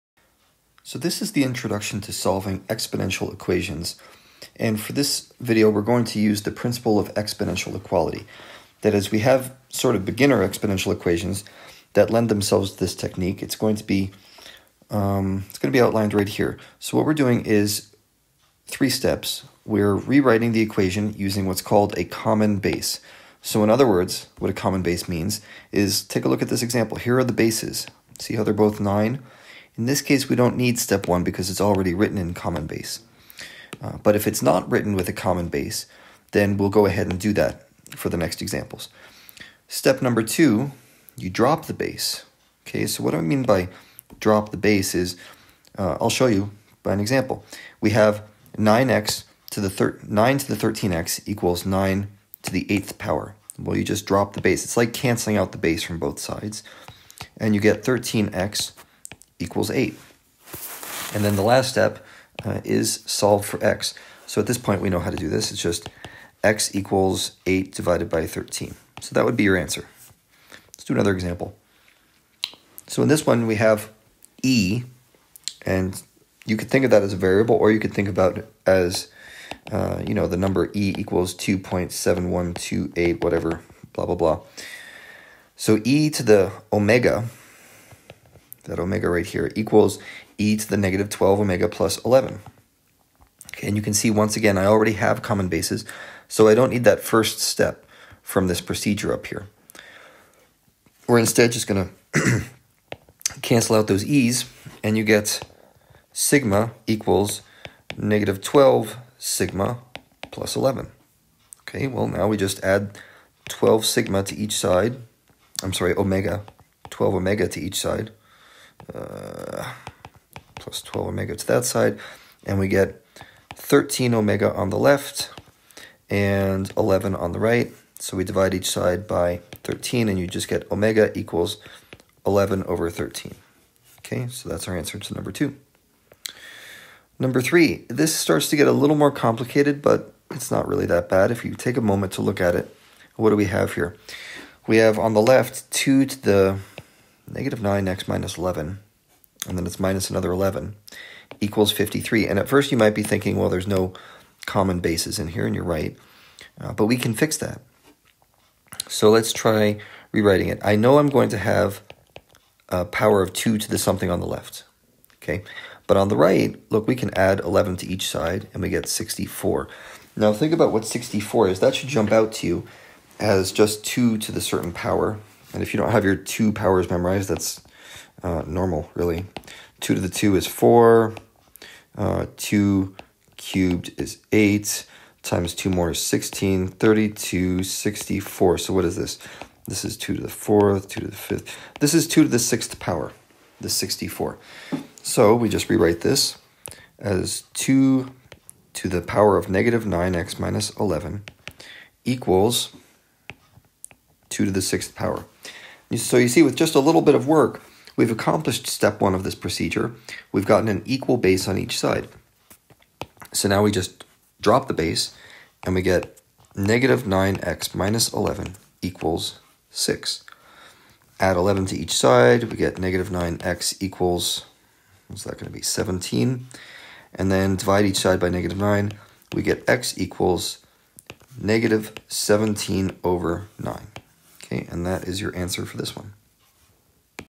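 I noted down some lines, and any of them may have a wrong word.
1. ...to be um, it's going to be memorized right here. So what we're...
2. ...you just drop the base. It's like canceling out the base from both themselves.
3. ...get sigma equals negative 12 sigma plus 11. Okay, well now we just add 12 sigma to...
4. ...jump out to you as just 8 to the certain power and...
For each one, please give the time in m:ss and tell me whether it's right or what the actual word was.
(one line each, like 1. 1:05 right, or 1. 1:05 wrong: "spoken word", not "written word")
1. 0:13 wrong: "outlined", not "memorized"
2. 0:53 wrong: "sides", not "themselves"
3. 1:45 right
4. 2:51 wrong: "2", not "8".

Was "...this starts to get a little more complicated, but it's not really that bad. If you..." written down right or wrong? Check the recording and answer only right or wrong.
right.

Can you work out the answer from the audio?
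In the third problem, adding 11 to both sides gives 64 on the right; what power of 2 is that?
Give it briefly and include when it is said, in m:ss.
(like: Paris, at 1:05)
6th power, at 3:12.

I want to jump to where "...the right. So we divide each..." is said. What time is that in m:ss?
2:07.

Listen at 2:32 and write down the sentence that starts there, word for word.
And at first you might be thinking, well, there's no common bases in here, and you're right.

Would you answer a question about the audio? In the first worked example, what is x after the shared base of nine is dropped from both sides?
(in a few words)
8/13.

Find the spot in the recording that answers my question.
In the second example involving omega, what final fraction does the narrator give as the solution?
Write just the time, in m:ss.
2:12.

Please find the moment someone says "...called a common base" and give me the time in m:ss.
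0:21.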